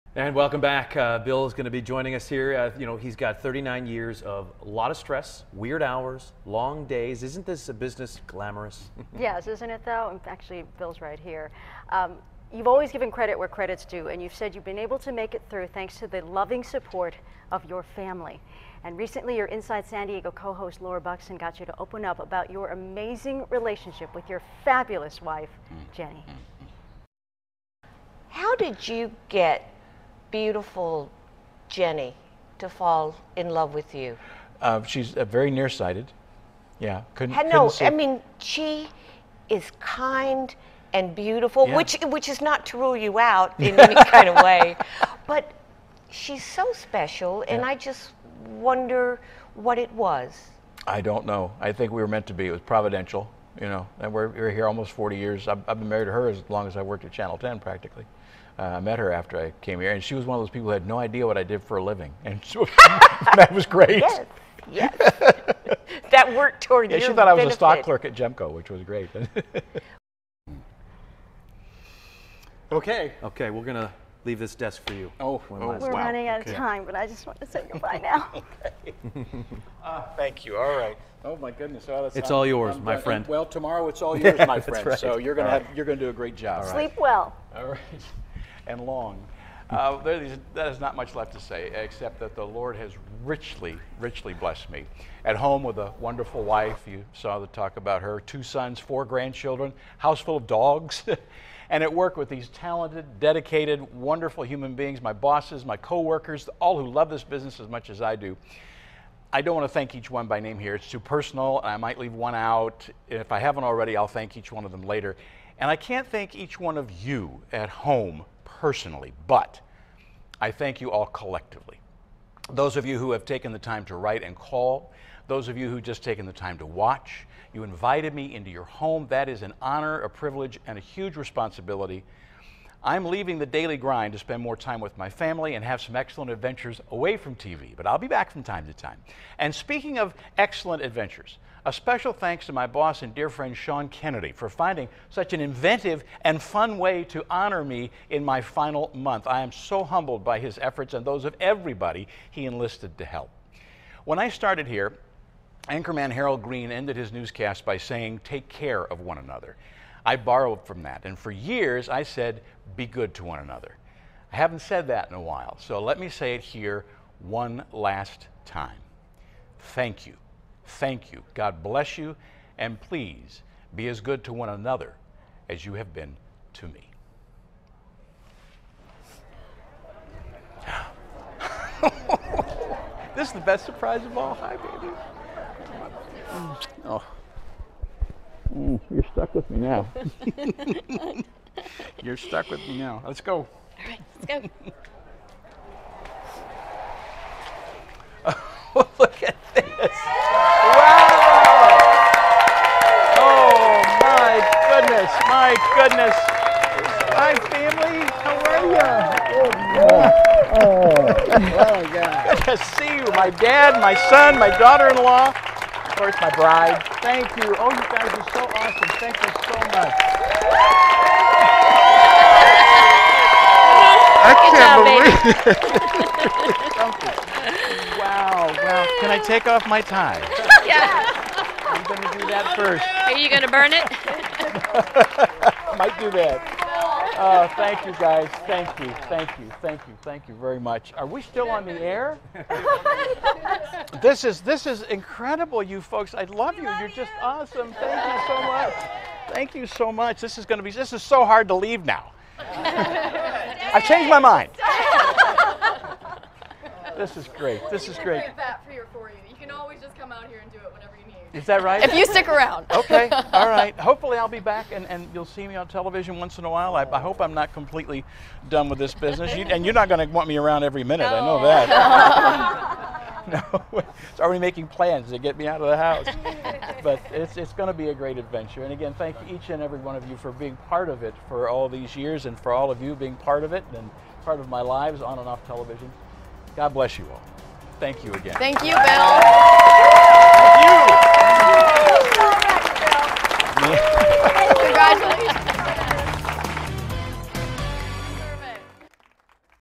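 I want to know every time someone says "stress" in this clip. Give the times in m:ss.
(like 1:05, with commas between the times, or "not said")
0:04.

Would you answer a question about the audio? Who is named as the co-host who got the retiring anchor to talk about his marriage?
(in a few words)
Laura Buxton.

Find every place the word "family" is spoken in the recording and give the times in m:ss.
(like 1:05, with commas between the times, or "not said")
0:17, 2:15, 3:27.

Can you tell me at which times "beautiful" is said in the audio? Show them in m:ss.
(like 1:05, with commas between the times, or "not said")
0:30, 0:41.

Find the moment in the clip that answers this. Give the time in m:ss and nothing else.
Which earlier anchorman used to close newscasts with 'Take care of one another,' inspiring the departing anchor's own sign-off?
2:36.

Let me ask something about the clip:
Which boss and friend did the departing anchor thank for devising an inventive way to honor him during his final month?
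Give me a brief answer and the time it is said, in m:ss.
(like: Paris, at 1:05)
Sean Kennedy, at 2:23.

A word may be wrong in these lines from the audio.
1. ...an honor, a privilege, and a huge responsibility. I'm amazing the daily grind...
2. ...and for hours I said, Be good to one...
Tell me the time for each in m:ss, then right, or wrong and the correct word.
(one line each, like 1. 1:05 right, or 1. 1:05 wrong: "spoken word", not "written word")
1. 2:09 wrong: "leaving", not "amazing"
2. 2:41 wrong: "years", not "hours".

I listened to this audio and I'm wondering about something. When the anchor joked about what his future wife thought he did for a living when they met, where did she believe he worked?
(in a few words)
Gemco.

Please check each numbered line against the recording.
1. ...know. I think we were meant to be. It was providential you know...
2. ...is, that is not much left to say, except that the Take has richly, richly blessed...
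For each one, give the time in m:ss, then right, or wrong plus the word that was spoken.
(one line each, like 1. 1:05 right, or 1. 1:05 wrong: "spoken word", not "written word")
1. 0:51 right
2. 1:30 wrong: "Lord", not "Take".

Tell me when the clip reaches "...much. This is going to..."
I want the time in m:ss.
4:09.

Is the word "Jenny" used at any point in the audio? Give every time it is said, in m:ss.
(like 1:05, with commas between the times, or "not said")
0:25, 0:31.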